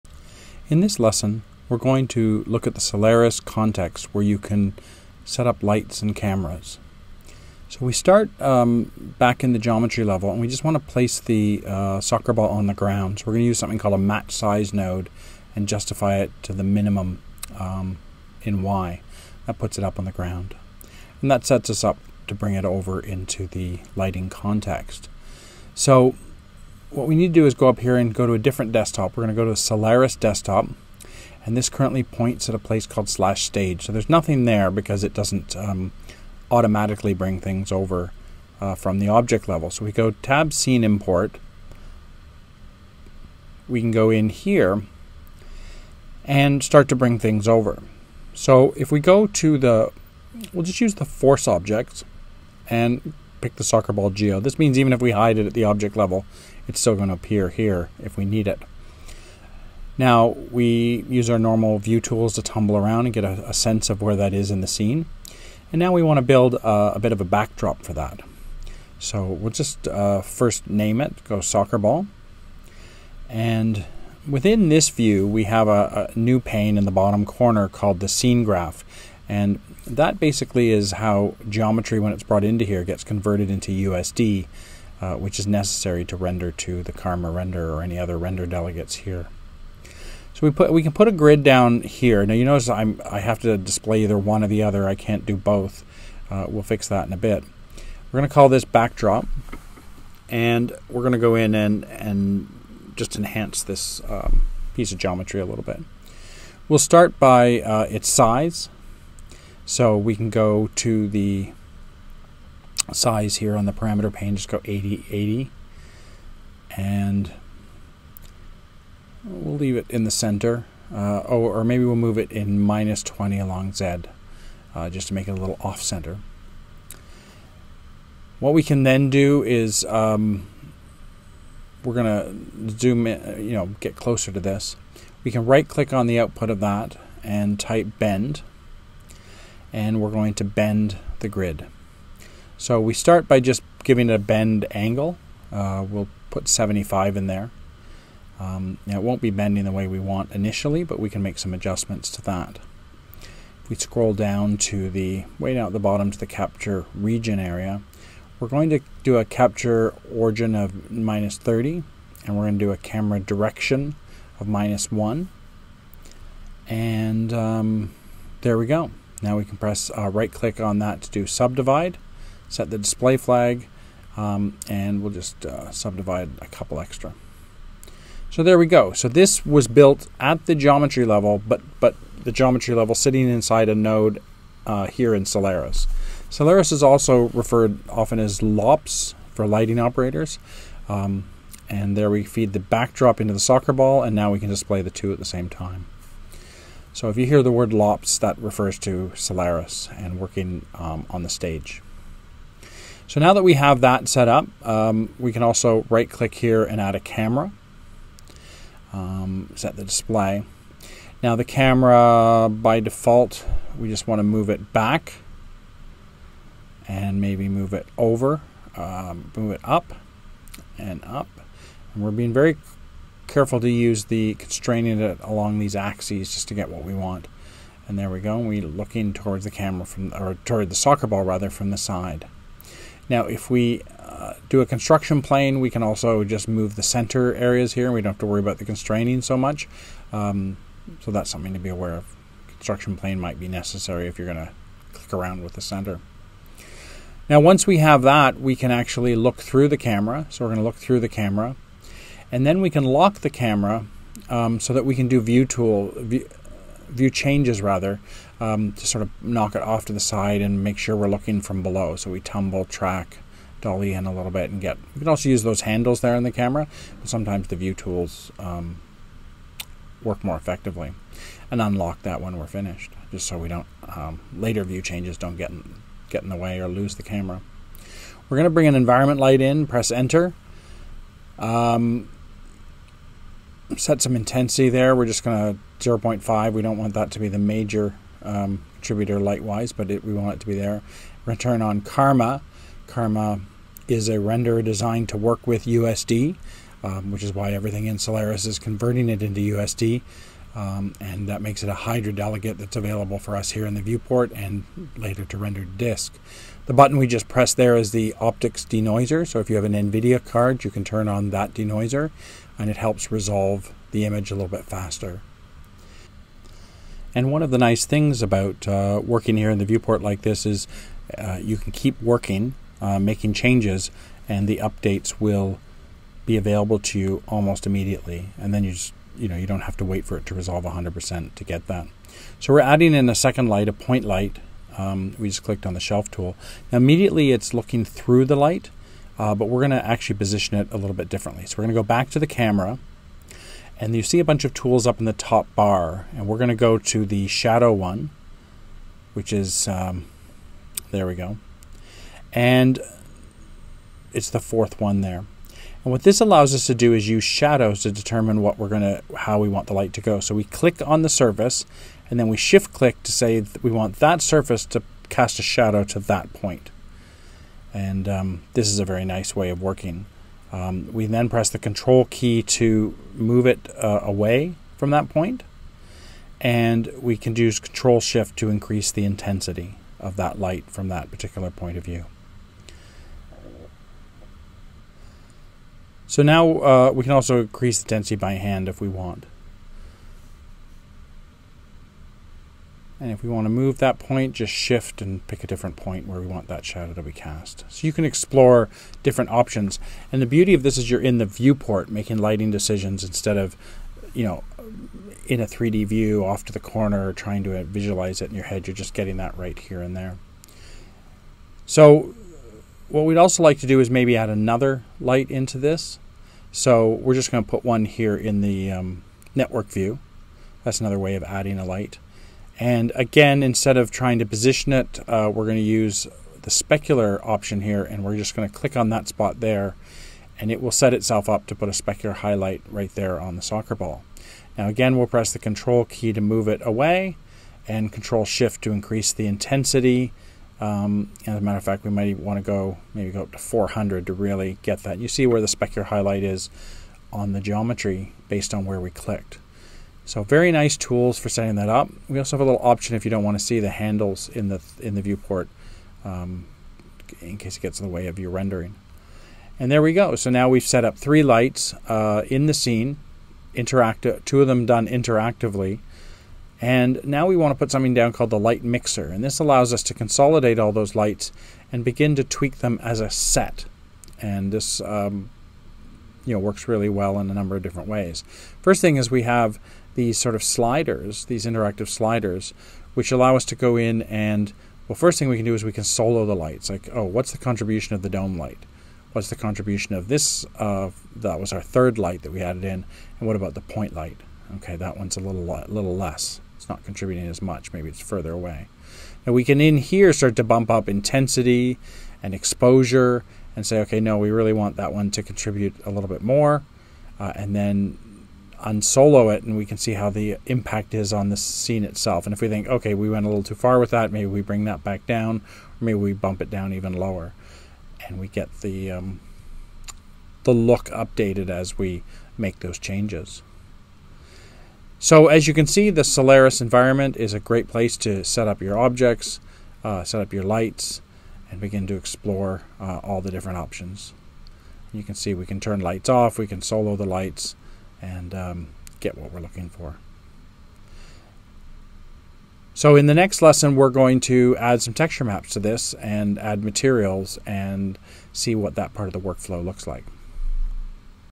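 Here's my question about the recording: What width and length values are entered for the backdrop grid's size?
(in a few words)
80, 80.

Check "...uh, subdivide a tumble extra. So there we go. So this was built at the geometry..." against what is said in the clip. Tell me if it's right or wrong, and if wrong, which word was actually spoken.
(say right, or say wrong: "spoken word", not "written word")
wrong: "couple", not "tumble".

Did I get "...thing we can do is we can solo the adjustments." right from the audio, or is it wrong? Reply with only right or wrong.
wrong.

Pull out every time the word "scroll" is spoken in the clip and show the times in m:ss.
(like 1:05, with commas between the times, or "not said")
2:33.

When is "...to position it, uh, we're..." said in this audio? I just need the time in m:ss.
7:04.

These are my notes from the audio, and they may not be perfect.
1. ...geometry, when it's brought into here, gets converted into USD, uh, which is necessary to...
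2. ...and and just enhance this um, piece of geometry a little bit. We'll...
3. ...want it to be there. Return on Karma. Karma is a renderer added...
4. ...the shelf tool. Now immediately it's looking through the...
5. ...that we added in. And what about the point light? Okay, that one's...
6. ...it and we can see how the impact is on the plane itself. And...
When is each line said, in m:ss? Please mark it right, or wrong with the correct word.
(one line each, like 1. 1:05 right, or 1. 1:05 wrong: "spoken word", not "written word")
1. 1:21 right
2. 1:41 right
3. 4:50 wrong: "designed", not "added"
4. 5:35 right
5. 8:12 right
6. 8:29 wrong: "scene", not "plane".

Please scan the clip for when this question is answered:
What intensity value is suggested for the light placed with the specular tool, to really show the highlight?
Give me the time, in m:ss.
7:23.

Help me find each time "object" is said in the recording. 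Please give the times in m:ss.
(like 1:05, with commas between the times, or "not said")
0:39, 0:51, 0:55, 8:48.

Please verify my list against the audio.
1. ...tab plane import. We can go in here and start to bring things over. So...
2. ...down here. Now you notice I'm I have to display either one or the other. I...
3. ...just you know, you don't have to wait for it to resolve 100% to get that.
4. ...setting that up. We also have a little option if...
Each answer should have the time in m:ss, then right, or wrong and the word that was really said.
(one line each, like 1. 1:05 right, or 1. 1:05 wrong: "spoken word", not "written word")
1. 0:40 wrong: "scene", not "plane"
2. 1:31 right
3. 5:28 right
4. 7:31 right.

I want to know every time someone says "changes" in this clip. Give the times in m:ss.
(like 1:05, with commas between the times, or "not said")
4:17, 4:34, 5:23, 8:42.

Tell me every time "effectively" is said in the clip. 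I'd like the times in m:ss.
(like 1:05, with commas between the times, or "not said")
4:30.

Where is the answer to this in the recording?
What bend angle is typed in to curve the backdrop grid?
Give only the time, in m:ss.
2:26.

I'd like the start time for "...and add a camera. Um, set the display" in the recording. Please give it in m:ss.
3:26.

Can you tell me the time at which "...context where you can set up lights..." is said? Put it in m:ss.
0:03.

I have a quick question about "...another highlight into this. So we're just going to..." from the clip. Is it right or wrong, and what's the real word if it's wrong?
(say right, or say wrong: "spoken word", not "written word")
wrong: "light", not "highlight".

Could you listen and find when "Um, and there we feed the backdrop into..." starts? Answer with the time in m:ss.
3:10.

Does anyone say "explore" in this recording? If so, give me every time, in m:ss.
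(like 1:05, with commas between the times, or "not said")
6:38, 8:51.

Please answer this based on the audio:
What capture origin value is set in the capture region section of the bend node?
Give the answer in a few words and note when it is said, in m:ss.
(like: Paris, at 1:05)
-30, at 2:40.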